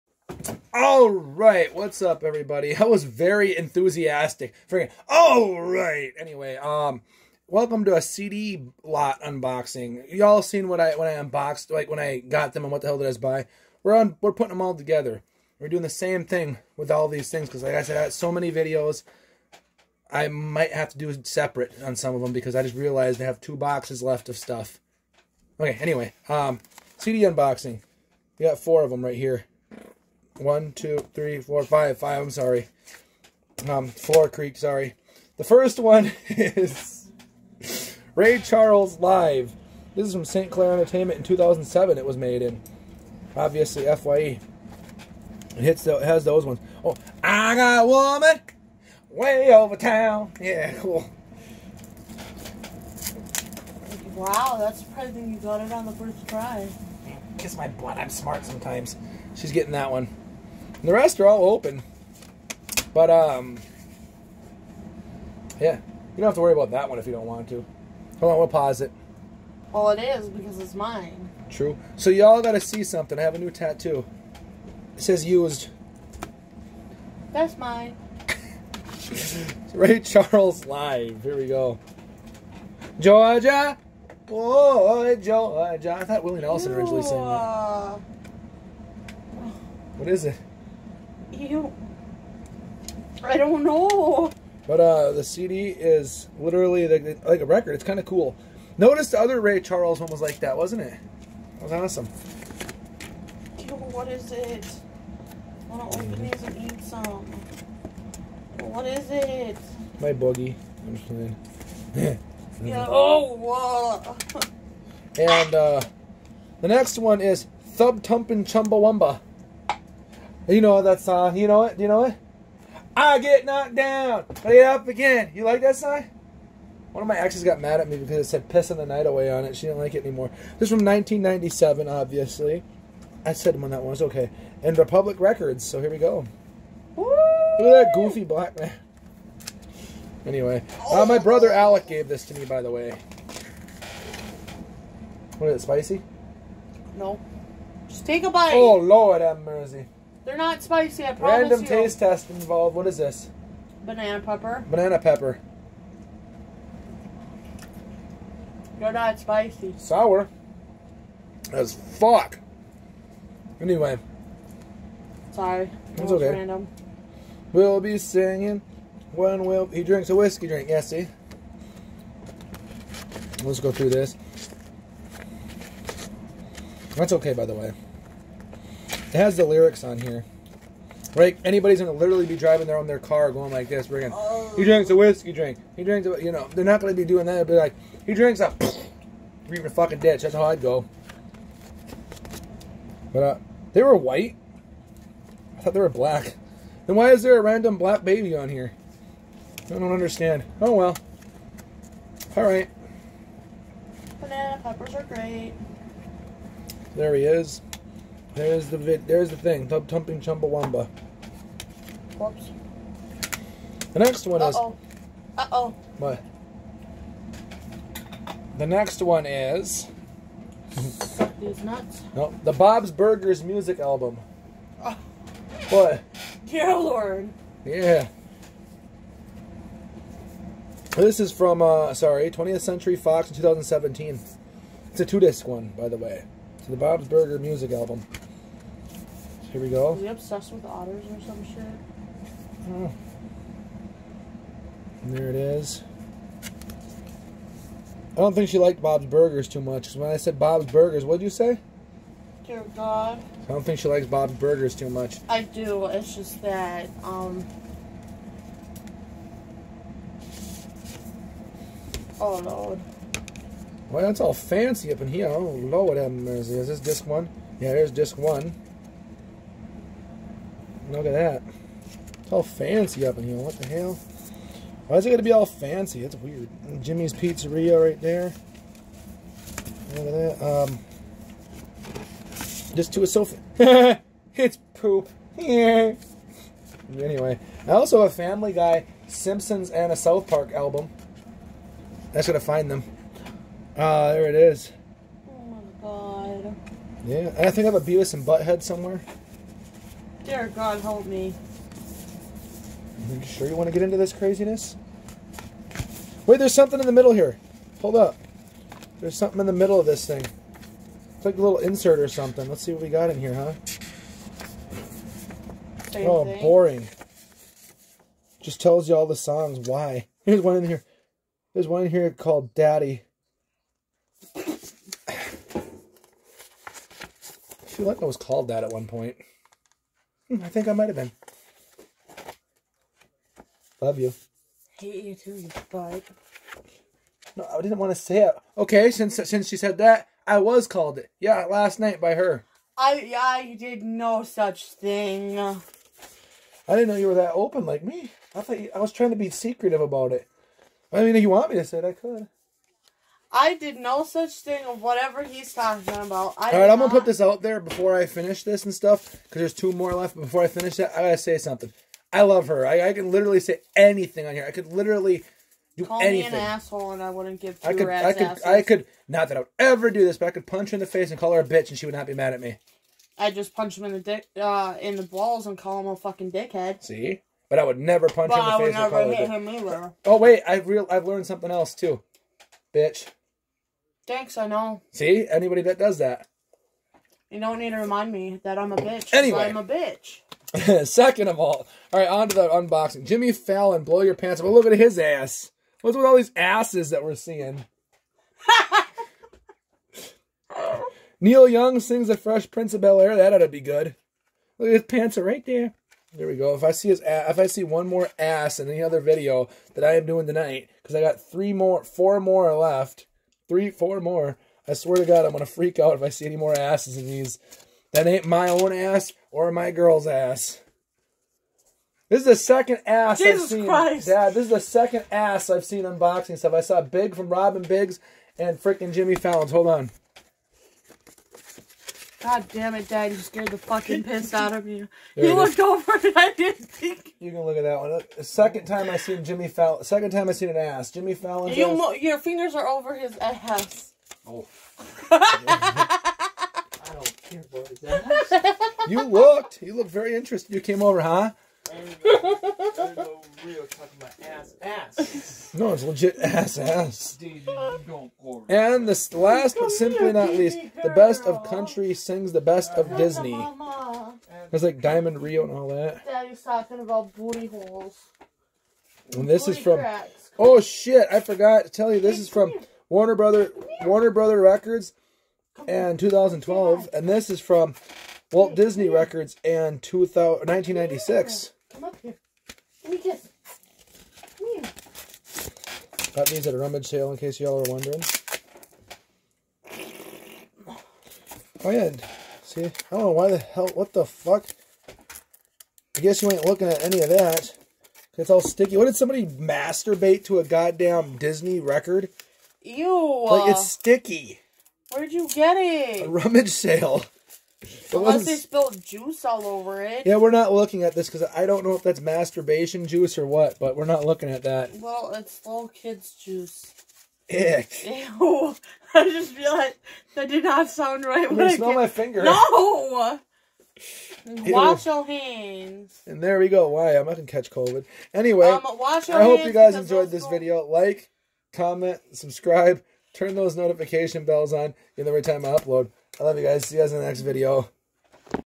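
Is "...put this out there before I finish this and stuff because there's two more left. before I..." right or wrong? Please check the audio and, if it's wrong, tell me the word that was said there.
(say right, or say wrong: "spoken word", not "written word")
right.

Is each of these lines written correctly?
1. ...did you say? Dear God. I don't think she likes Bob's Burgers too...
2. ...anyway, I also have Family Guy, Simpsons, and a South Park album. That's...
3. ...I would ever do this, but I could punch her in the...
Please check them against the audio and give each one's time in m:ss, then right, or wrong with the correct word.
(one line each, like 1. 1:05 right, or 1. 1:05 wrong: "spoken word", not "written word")
1. 4:11 right
2. 4:46 right
3. 6:09 right.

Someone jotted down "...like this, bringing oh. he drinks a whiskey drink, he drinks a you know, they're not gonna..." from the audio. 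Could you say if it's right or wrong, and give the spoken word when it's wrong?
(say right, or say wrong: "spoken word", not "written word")
right.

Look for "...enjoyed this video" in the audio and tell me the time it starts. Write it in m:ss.
8:49.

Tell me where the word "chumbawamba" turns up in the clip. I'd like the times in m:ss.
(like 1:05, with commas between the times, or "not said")
1:58, 3:30.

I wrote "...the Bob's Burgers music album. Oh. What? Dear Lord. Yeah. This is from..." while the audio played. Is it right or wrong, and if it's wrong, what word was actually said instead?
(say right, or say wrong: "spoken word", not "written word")
right.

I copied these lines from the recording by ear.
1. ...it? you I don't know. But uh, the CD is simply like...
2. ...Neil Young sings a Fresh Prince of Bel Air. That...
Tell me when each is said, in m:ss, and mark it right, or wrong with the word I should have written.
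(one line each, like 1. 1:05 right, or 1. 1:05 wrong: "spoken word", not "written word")
1. 1:30 wrong: "literally", not "simply"
2. 6:41 right.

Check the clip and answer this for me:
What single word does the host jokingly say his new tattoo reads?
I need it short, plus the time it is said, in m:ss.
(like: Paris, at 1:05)
used, at 1:15.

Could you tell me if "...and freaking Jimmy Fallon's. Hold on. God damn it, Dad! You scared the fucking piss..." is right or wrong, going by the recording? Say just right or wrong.
right.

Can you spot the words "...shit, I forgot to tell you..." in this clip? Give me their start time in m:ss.
7:50.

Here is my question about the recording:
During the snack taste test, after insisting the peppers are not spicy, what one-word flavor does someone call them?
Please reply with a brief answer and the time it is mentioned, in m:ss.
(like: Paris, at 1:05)
Sour, at 2:39.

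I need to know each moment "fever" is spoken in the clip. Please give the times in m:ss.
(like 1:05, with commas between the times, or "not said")
not said.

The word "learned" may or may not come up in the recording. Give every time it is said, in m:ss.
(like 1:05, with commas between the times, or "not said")
6:21.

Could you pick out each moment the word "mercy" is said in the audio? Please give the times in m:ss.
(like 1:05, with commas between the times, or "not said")
2:29, 4:26.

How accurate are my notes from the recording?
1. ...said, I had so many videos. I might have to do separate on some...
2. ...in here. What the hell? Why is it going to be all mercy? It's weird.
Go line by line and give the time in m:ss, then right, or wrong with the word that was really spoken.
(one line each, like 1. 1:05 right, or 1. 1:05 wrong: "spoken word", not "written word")
1. 0:17 right
2. 4:33 wrong: "fancy", not "mercy".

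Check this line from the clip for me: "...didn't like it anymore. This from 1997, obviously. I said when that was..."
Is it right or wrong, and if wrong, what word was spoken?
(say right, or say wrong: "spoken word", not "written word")
right.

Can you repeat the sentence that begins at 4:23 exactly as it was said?
Well, that's all fancy up in here.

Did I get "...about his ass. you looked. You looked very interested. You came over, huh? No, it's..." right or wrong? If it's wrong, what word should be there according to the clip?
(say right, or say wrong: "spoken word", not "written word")
right.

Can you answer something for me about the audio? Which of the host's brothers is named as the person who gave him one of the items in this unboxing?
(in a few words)
Alec.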